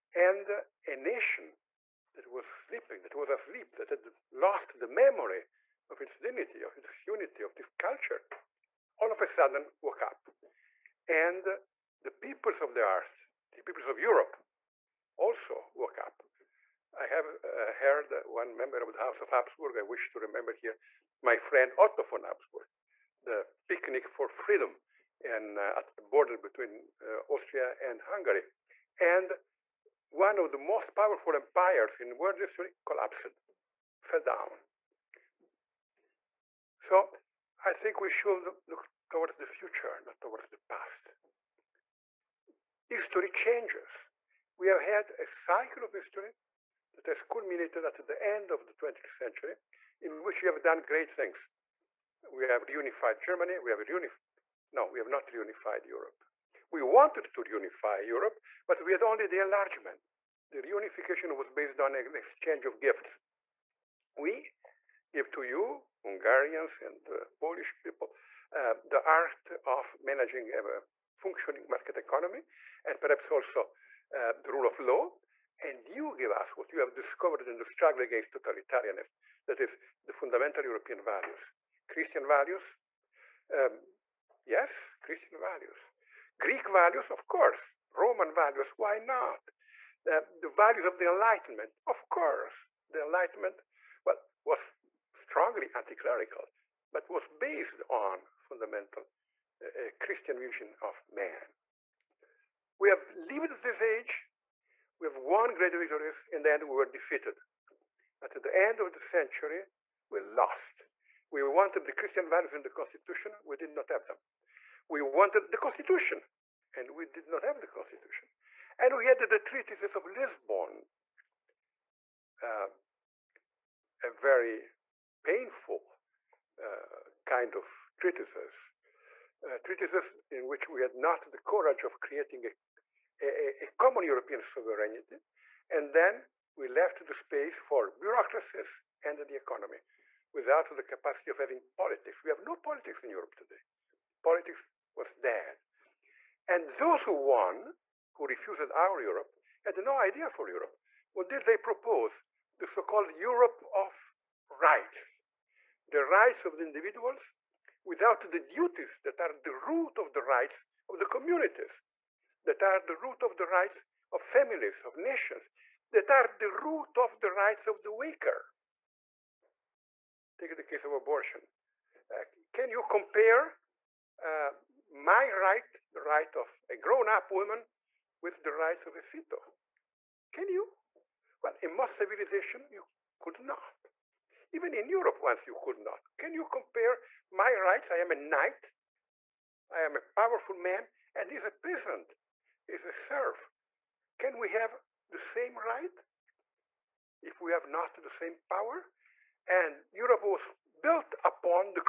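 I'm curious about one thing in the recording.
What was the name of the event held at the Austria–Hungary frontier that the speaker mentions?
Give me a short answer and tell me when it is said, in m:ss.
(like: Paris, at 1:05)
Picnic for freedom, at 0:23.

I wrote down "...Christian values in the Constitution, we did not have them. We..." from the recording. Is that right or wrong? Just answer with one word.
right.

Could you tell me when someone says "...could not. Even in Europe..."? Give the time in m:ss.
3:03.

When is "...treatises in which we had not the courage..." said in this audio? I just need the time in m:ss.
2:09.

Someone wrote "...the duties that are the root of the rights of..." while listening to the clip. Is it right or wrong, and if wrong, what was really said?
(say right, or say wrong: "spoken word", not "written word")
right.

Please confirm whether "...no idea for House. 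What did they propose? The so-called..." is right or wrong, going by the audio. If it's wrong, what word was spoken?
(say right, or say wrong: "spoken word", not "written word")
wrong: "Europe", not "House".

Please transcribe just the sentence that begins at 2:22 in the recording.
We have no politics in Europe today.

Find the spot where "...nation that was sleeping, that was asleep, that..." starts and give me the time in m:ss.
0:00.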